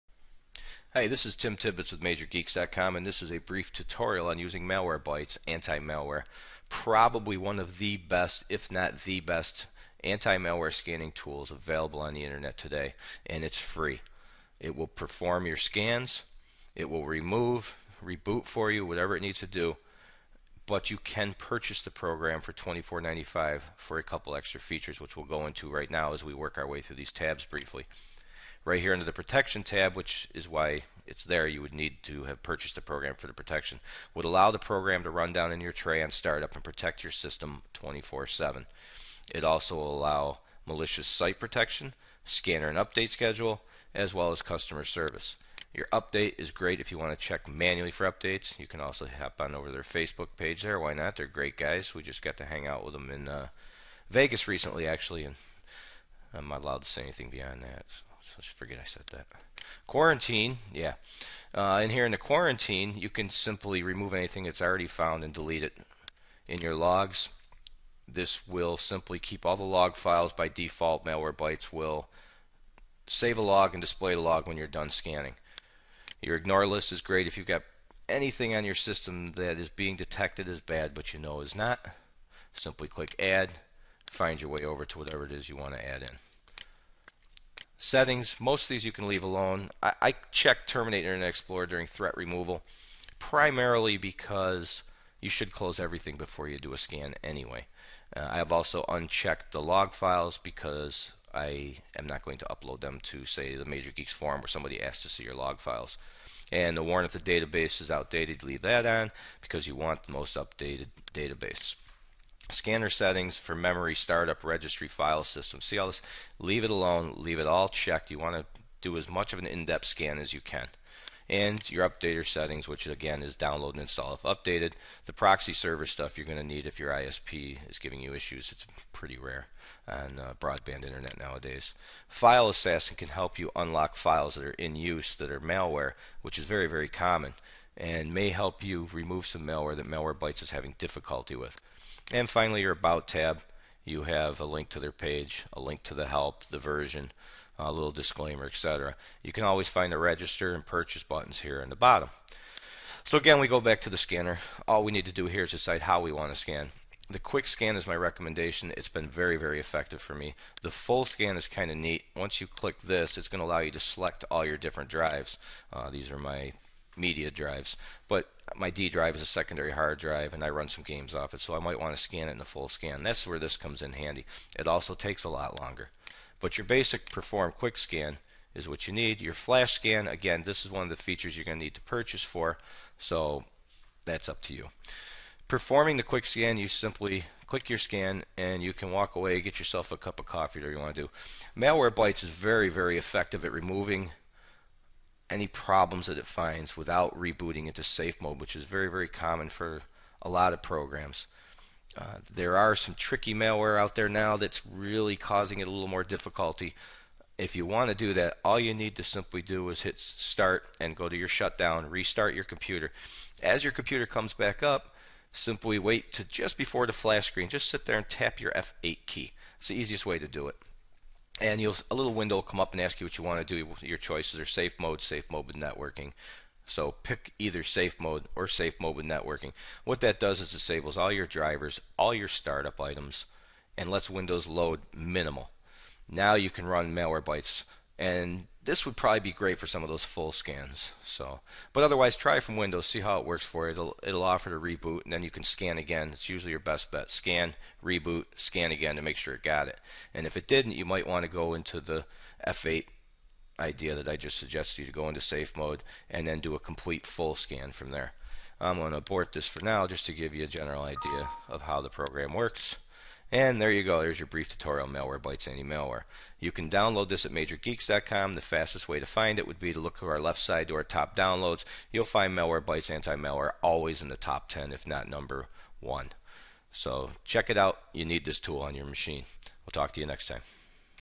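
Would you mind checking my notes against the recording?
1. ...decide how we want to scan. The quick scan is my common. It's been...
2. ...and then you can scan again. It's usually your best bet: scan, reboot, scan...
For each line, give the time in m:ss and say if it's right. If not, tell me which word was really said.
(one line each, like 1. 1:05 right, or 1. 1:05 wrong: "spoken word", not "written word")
1. 2:35 wrong: "recommendation", not "common"
2. 4:05 right.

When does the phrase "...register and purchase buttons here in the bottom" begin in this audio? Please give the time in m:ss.
2:29.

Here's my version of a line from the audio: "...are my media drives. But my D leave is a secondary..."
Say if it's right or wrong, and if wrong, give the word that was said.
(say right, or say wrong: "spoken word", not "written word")
wrong: "drive", not "leave".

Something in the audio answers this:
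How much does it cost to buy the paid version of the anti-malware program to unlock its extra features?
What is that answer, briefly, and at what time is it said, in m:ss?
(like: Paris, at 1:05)
$24.95, at 0:22.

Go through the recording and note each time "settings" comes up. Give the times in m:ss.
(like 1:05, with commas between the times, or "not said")
1:27, 1:52, 2:02.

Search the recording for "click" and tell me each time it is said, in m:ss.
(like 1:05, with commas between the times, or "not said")
1:22, 2:42, 3:07.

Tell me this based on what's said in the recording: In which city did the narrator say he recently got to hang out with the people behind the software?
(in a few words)
Vegas.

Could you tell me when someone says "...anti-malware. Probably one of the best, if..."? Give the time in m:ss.
0:05.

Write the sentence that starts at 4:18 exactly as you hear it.
I'm going to abort this for now just to give you a general idea of how the program works.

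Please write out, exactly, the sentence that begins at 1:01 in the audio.
Uh, and here in the quarantine, you can simply remove anything that's already found and delete it in your logs.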